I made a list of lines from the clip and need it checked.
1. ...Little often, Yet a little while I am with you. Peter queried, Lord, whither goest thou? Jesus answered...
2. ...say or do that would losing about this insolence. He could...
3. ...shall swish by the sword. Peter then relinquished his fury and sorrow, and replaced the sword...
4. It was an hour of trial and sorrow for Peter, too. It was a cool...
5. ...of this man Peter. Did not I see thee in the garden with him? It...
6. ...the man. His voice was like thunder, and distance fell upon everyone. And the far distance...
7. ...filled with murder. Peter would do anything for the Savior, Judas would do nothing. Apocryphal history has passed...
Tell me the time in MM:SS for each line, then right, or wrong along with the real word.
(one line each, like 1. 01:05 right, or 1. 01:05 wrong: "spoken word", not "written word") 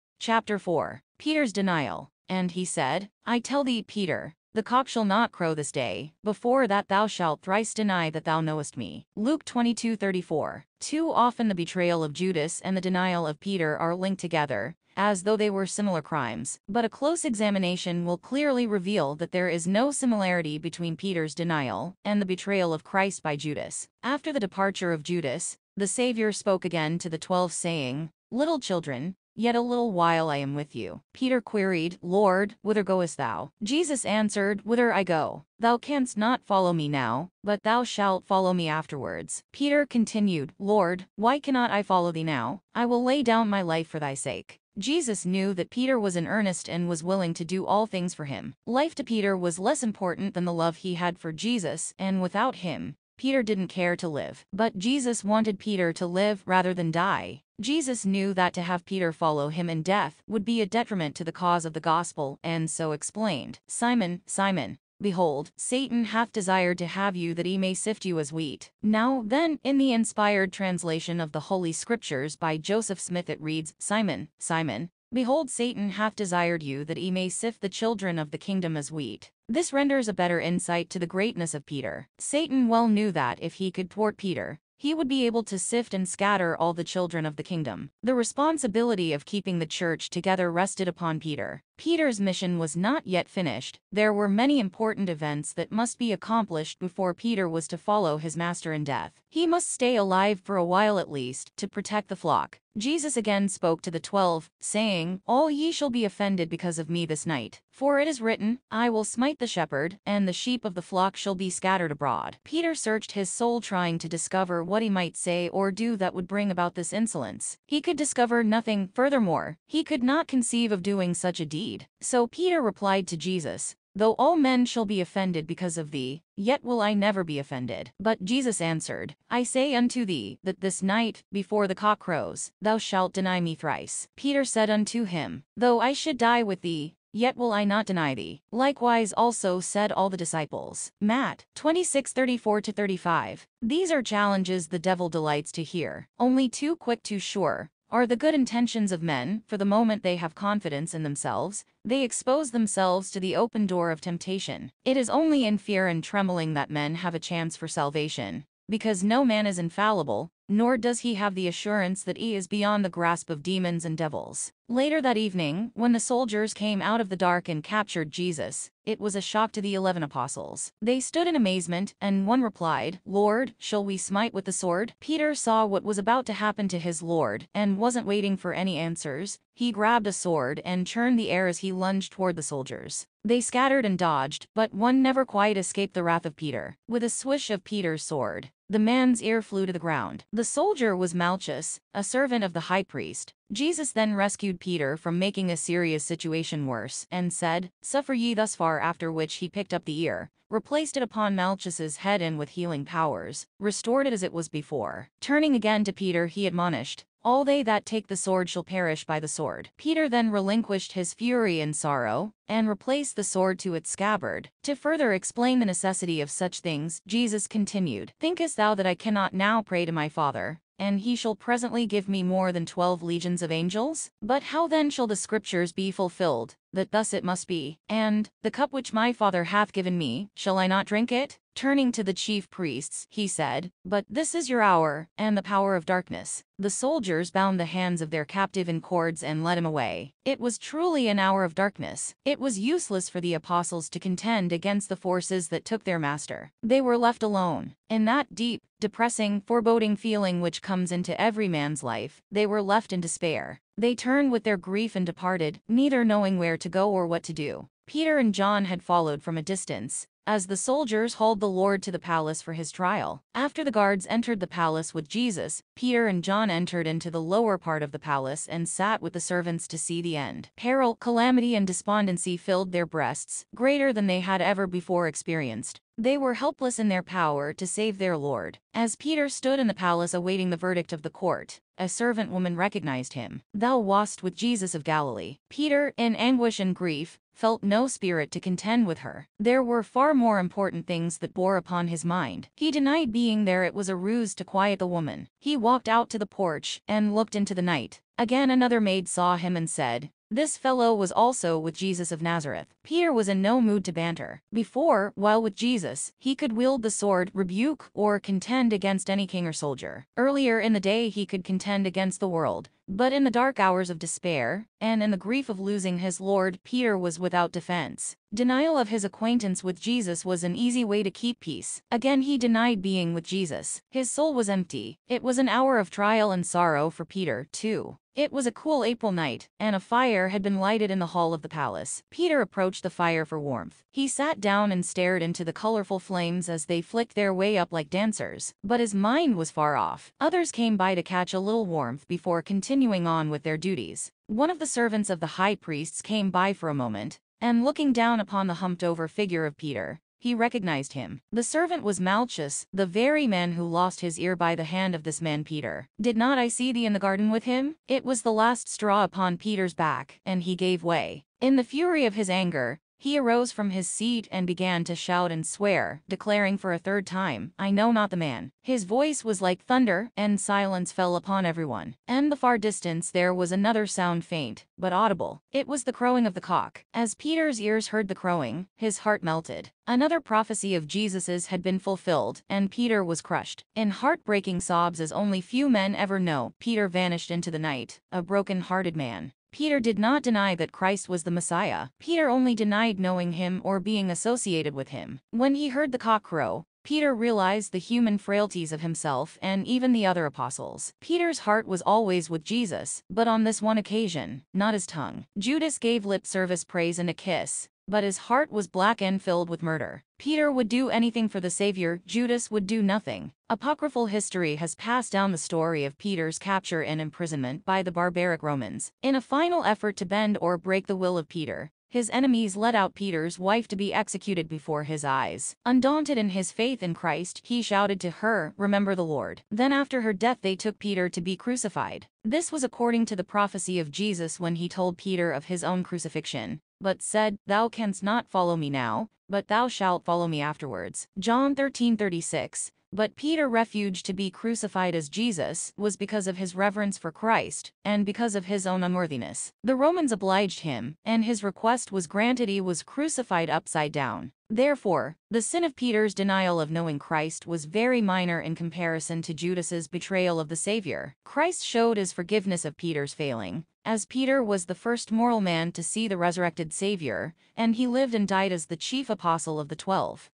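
1. 00:28 wrong: "children", not "often"
2. 01:55 wrong: "bring", not "losing"
3. 03:28 wrong: "perish", not "swish"
4. 05:25 right
5. 05:54 right
6. 06:08 wrong: "silence", not "distance"
7. 06:49 right.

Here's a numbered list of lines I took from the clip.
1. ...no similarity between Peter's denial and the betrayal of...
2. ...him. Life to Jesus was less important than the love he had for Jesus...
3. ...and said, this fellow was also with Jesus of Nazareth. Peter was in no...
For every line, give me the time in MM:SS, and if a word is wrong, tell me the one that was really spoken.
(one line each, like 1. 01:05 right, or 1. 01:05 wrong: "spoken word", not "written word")
1. 00:19 right
2. 00:48 wrong: "Peter", not "Jesus"
3. 04:59 right.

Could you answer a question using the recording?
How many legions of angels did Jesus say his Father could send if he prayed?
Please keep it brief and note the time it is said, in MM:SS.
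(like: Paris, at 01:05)
12, at 03:42.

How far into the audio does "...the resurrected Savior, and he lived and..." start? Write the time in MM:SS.
07:46.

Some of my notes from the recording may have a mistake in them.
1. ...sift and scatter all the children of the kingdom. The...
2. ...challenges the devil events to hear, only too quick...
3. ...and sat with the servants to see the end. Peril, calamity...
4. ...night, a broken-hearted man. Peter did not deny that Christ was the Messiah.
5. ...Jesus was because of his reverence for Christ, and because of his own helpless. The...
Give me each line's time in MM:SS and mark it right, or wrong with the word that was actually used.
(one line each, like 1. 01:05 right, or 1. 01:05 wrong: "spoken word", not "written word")
1. 01:25 right
2. 02:24 wrong: "delights", not "events"
3. 04:28 right
4. 06:27 right
5. 07:25 wrong: "unworthiness", not "helpless".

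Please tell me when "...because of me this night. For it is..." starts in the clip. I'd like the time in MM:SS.
01:46.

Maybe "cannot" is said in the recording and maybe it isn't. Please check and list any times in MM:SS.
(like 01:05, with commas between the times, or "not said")
00:41, 03:38.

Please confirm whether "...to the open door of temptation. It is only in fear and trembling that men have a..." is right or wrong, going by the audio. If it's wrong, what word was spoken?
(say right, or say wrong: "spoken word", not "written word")
right.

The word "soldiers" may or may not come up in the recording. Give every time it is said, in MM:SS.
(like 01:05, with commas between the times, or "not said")
02:45, 03:02, 03:10, 03:56, 04:20, 05:09.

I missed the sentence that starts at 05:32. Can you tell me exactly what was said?
Peter approached the fire for warmth.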